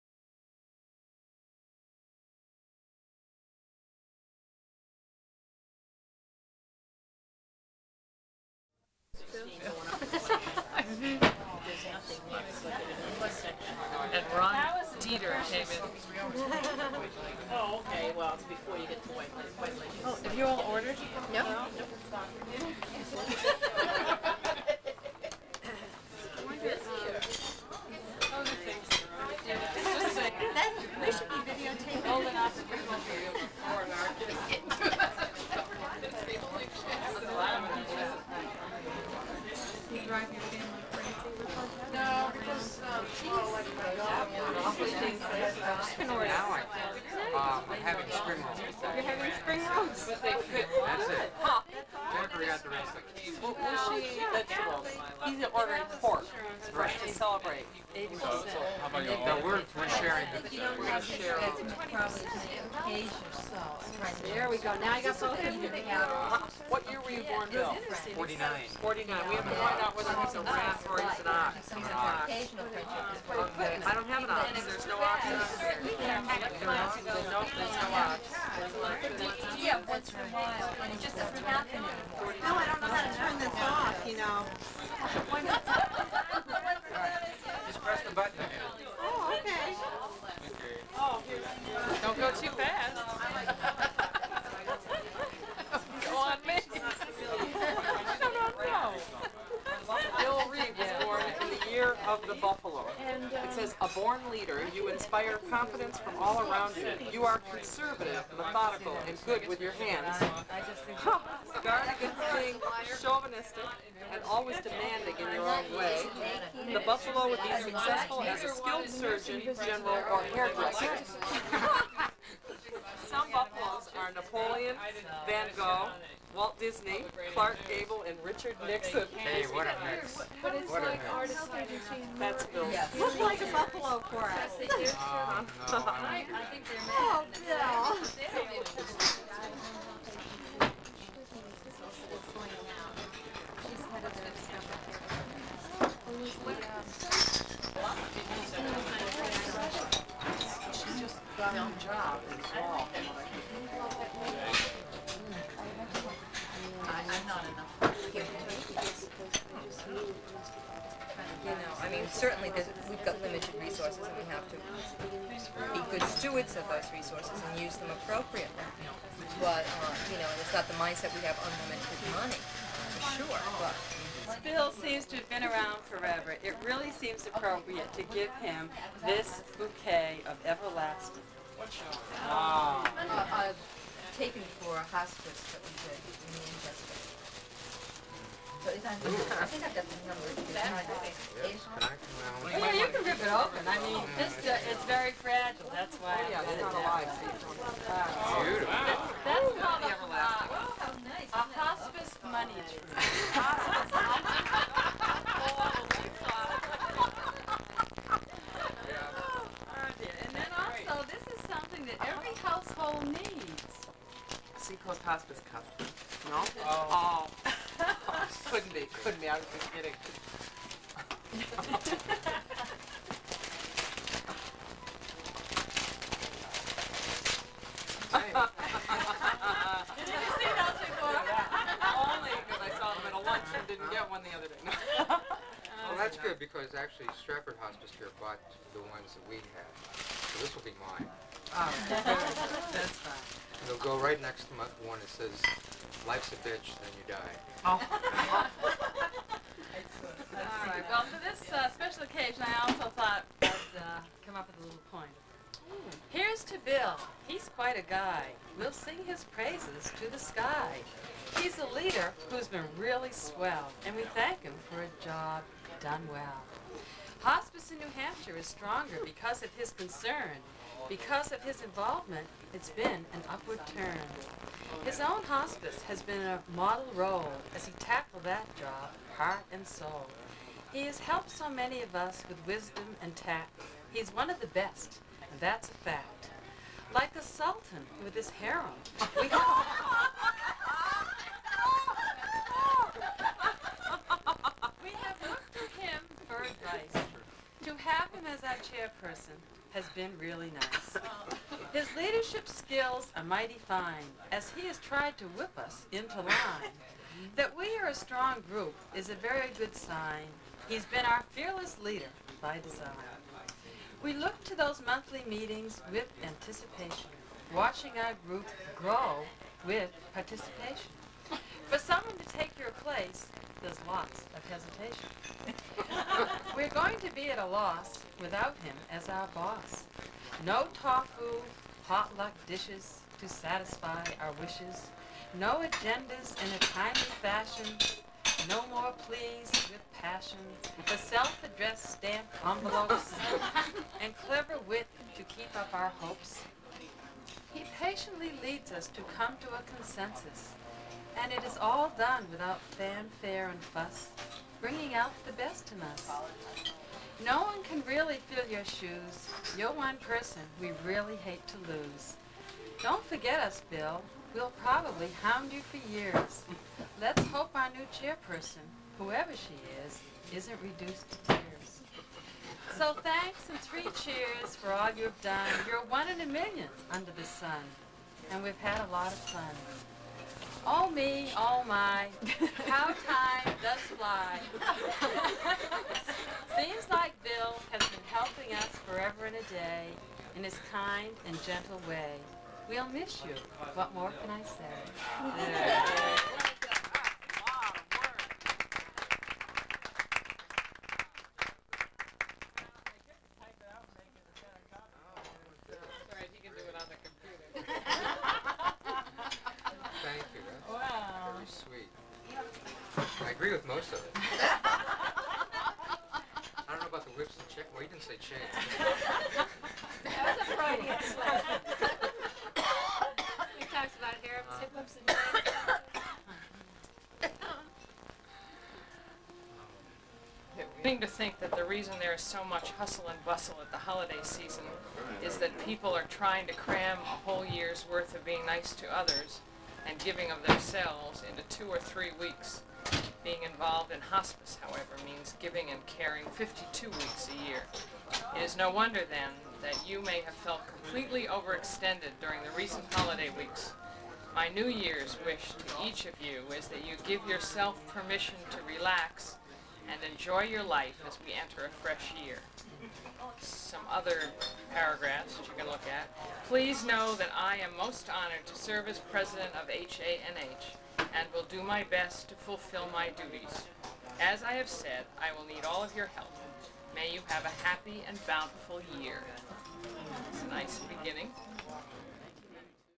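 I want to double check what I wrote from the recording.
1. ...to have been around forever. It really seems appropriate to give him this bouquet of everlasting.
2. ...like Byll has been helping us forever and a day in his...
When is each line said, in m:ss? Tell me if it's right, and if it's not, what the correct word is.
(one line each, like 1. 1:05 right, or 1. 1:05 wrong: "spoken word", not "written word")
1. 2:55 right
2. 6:26 right.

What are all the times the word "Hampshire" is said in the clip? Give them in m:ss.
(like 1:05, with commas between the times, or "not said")
4:27.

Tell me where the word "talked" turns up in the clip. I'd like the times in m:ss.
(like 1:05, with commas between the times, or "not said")
7:03.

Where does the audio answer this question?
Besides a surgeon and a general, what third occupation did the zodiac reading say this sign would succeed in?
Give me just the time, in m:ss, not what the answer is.
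2:00.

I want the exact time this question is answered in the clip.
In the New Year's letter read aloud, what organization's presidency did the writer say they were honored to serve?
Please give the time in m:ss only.
7:49.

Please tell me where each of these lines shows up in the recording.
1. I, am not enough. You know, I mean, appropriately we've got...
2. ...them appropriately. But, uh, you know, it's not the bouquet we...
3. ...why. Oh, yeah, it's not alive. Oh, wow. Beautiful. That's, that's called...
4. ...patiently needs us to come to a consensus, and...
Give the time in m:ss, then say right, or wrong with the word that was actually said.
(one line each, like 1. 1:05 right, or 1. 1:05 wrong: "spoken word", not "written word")
1. 2:36 wrong: "certainly", not "appropriately"
2. 2:47 wrong: "mindset", not "bouquet"
3. 3:15 right
4. 5:47 wrong: "leads", not "needs".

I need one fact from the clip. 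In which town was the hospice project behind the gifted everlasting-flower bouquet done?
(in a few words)
Manchester.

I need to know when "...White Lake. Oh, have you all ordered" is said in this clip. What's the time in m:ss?
0:19.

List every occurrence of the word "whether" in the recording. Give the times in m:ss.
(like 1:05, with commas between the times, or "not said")
1:09.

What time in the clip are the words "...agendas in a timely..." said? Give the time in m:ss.
5:35.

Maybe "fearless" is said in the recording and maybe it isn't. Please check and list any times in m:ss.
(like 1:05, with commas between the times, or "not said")
5:11.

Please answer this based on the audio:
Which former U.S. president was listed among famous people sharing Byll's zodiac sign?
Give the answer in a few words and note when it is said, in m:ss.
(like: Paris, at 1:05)
Richard Nixon, at 2:08.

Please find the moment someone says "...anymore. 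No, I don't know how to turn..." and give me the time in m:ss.
1:21.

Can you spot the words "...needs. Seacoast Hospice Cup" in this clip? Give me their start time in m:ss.
3:33.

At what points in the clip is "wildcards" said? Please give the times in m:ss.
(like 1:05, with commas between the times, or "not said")
not said.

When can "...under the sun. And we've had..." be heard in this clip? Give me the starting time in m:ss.
6:16.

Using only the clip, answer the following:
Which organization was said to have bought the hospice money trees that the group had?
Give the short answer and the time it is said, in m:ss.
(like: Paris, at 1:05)
Strafford Hospice Care, at 3:57.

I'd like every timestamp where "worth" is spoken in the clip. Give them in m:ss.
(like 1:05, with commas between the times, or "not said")
7:17.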